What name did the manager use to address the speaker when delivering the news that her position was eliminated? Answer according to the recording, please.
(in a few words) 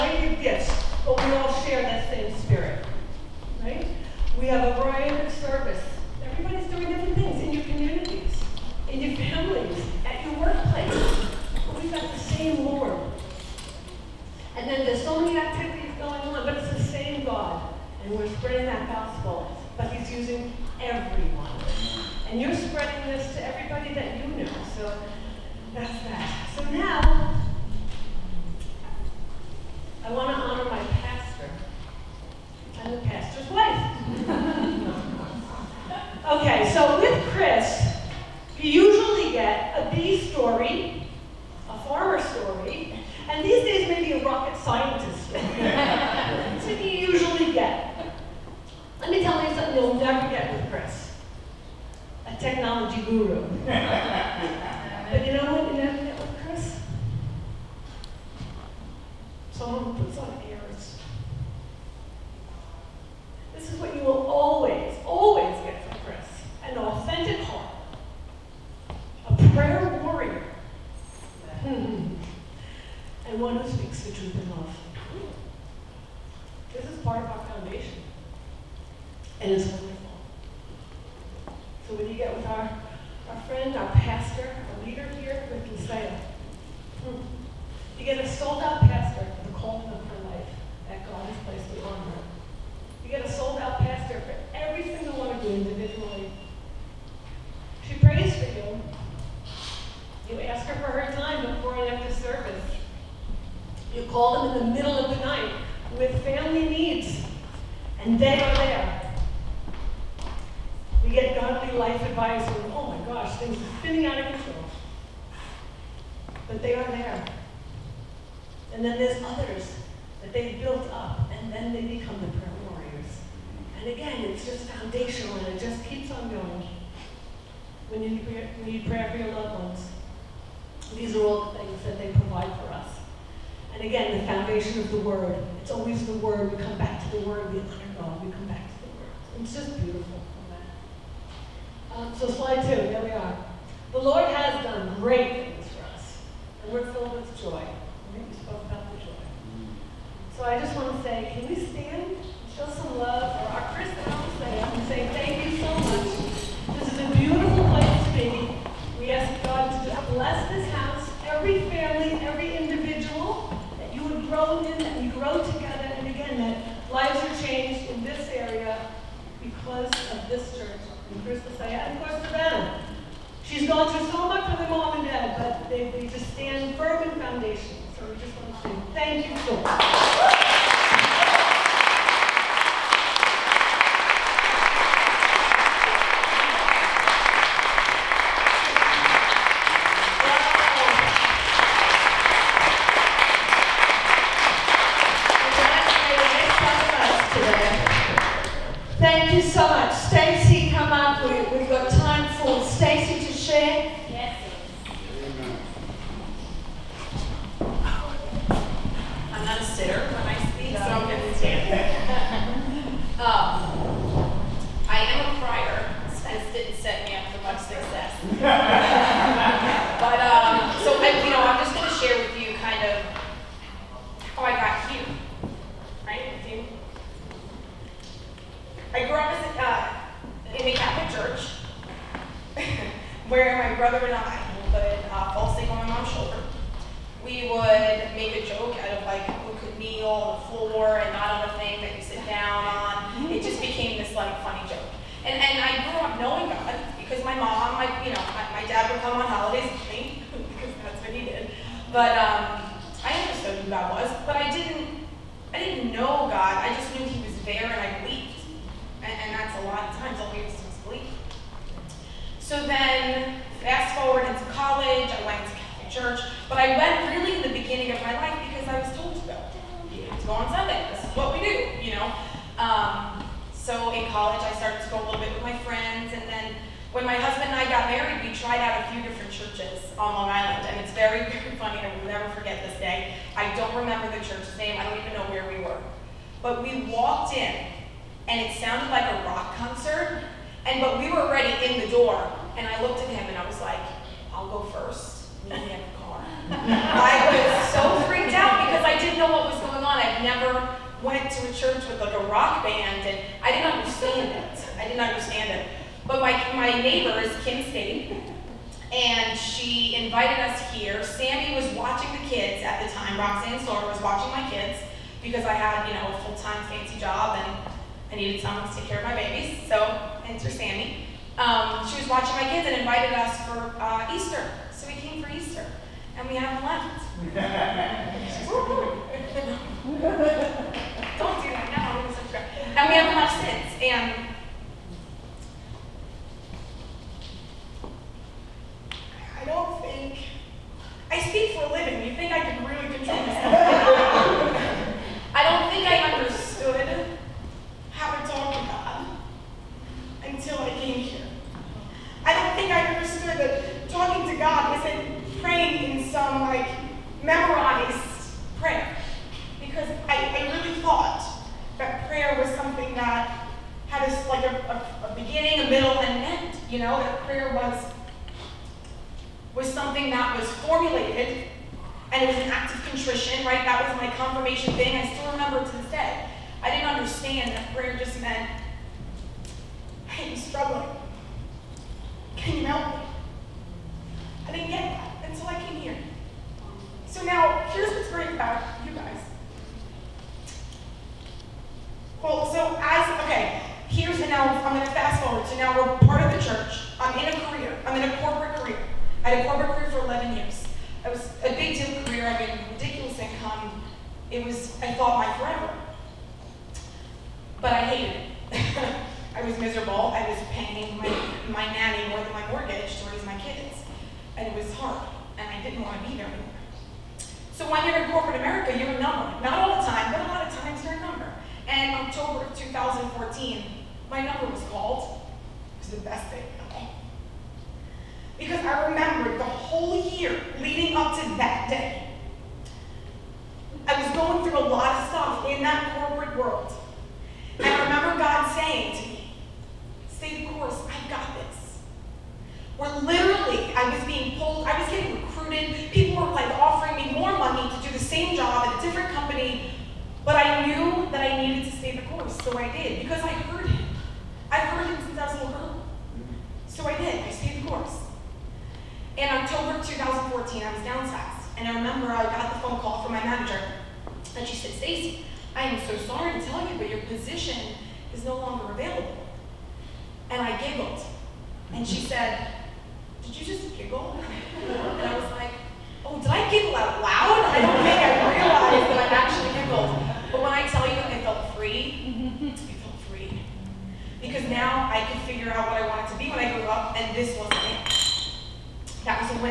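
Stacy.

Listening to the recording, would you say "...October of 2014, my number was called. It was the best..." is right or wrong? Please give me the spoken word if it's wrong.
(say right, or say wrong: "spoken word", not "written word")
right.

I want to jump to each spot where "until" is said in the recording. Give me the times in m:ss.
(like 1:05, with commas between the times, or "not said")
5:50, 6:25.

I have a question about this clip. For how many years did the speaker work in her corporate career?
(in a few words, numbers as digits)
11.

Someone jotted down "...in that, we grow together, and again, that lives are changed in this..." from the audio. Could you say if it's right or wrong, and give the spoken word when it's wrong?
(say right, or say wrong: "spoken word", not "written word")
right.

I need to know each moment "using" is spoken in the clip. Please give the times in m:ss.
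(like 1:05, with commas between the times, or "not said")
0:20.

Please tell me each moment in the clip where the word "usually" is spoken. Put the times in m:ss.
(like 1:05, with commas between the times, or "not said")
0:38, 0:46.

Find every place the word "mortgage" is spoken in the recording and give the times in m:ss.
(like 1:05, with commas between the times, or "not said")
6:52.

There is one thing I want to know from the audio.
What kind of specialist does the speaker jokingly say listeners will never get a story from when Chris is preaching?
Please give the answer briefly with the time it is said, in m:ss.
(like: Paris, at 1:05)
A technology guru, at 0:52.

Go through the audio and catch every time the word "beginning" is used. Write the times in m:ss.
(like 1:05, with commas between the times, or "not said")
4:27, 6:05.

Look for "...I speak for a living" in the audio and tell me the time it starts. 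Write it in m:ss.
5:41.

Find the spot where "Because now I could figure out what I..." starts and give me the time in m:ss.
8:04.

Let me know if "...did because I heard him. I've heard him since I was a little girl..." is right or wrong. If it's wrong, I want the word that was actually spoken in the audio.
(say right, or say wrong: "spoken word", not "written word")
right.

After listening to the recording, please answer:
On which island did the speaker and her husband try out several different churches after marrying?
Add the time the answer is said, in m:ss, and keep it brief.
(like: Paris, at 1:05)
Long Island, at 4:40.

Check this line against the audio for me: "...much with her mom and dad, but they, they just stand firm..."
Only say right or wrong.
right.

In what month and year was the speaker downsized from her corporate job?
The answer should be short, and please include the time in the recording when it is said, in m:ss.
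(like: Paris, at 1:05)
October 2014, at 7:39.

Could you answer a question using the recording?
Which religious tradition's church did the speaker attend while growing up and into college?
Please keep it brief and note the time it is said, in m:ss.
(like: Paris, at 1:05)
Catholic, at 4:25.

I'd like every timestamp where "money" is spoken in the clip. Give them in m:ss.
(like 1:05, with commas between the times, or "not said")
7:27.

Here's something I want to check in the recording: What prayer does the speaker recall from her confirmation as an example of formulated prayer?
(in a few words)
Act of contrition.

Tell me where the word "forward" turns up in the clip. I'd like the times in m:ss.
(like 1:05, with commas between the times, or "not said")
4:23, 6:35.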